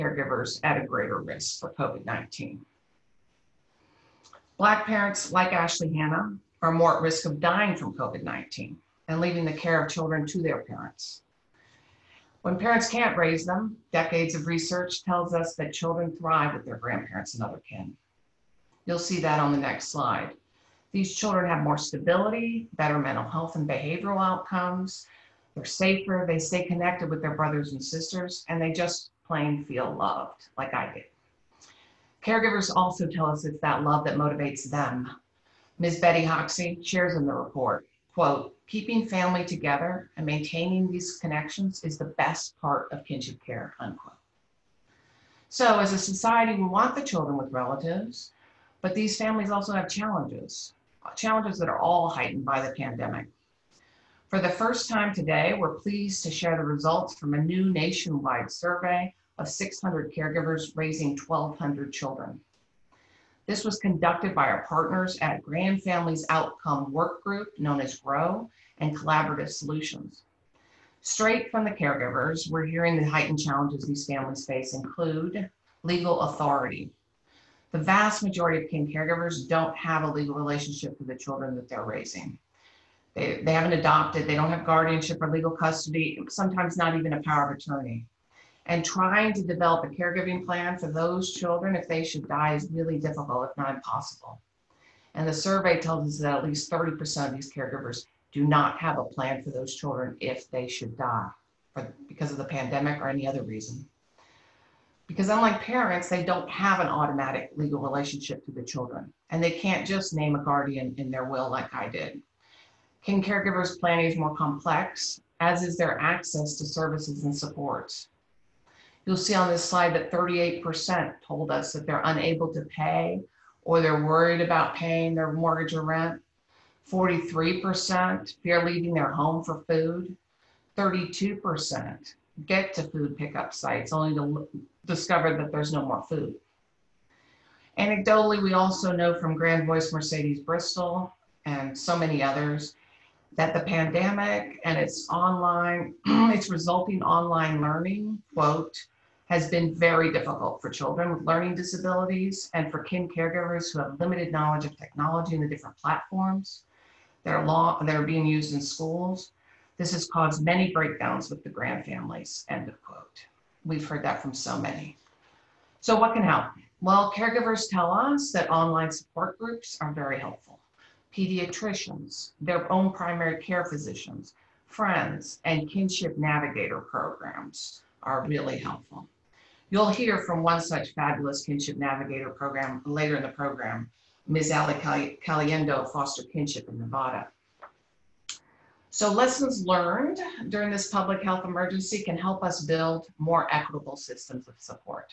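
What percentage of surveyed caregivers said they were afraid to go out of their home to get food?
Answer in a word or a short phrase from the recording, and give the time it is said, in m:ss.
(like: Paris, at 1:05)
43%, at 2:06.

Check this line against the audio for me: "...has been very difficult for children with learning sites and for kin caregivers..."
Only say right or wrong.
wrong.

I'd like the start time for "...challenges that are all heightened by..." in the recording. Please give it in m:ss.
0:51.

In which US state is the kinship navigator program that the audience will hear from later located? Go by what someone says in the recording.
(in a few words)
Nevada.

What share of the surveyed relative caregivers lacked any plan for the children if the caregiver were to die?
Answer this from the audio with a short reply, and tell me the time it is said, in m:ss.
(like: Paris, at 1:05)
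30%, at 1:36.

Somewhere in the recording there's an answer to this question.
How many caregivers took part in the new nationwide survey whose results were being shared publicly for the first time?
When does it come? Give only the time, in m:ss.
0:59.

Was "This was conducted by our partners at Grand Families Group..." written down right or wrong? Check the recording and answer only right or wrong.
wrong.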